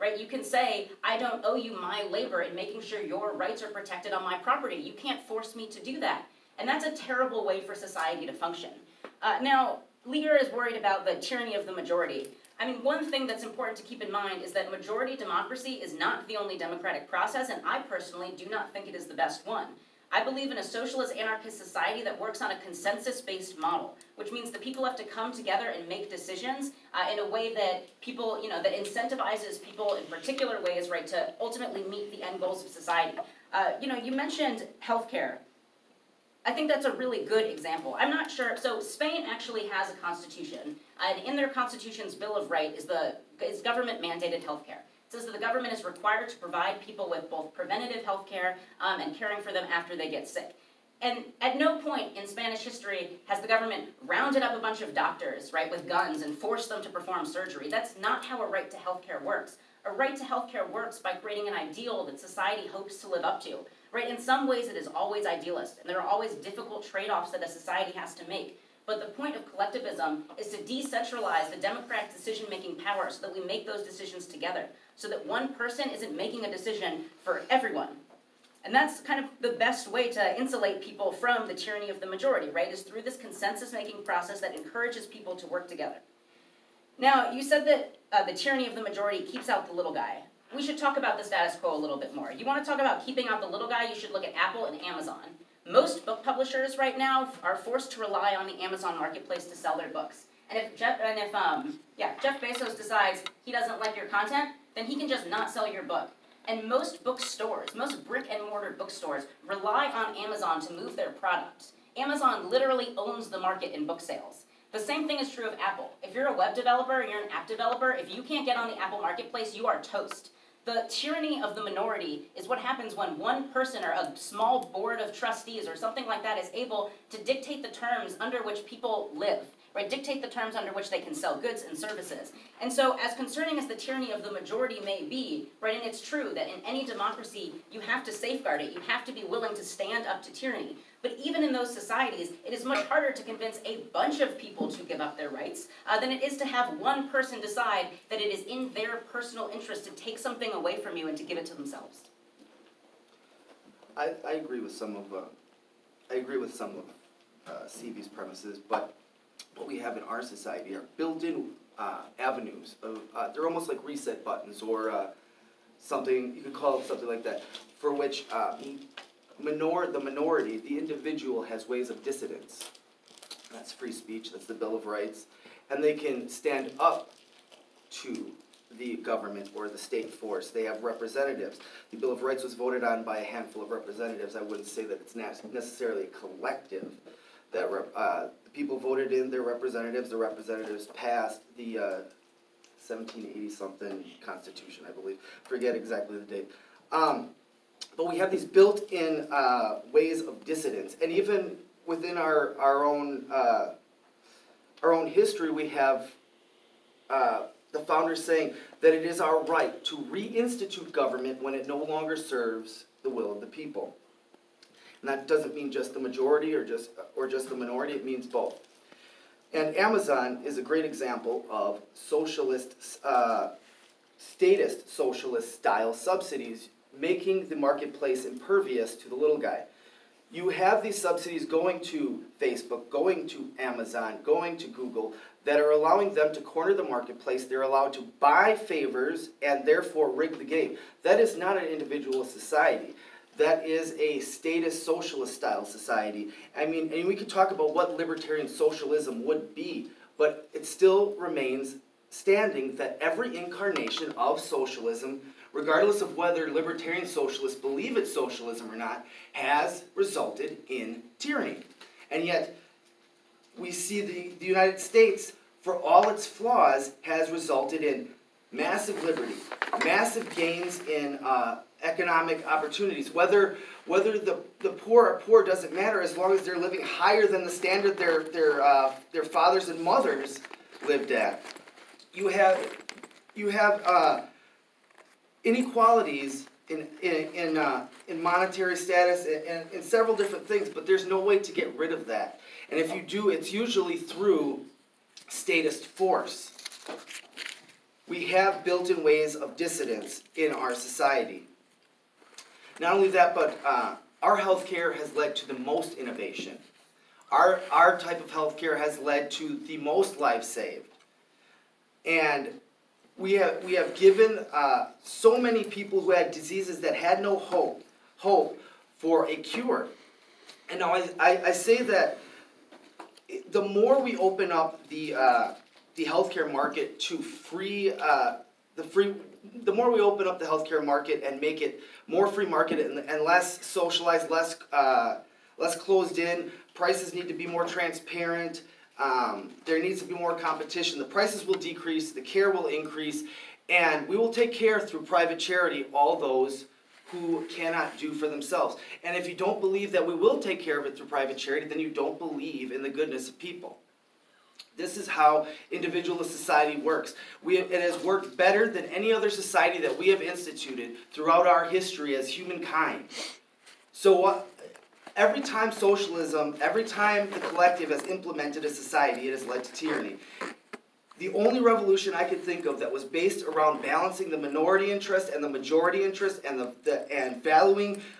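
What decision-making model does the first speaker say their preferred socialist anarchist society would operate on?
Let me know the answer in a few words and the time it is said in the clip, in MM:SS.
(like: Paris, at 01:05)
consensus-based model, at 00:22.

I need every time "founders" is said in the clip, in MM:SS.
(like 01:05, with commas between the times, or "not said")
03:27.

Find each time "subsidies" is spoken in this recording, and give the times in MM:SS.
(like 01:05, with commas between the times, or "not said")
03:45, 03:51.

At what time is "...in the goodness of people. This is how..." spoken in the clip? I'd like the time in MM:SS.
05:52.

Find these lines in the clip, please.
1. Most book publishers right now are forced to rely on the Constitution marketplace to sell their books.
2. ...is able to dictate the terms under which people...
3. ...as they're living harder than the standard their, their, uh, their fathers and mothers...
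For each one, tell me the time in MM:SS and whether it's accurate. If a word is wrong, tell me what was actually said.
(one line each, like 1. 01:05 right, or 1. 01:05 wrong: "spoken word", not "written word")
1. 01:35 wrong: "Amazon", not "Constitution"
2. 02:06 right
3. 04:36 wrong: "higher", not "harder".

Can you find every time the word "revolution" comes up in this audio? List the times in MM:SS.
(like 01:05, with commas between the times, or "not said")
06:11.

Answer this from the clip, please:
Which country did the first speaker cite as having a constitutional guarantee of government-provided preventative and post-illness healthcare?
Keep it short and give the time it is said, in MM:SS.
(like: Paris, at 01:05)
Spain, at 00:38.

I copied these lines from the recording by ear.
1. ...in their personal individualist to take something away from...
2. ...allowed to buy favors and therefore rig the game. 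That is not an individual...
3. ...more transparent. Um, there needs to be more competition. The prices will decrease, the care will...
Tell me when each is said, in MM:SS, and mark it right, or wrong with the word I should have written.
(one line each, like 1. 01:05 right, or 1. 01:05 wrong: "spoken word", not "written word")
1. 02:28 wrong: "interest", not "individualist"
2. 03:57 right
3. 05:37 right.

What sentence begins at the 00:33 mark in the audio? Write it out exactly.
Uh, you know, you mentioned healthcare.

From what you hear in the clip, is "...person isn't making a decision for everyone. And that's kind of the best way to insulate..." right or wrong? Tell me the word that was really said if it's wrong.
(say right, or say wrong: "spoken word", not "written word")
right.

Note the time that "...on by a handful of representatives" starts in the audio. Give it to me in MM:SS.
03:02.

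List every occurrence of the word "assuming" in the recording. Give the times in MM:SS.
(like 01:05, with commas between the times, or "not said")
not said.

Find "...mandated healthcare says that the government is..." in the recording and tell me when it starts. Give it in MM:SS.
00:44.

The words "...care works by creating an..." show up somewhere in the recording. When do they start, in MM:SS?
01:00.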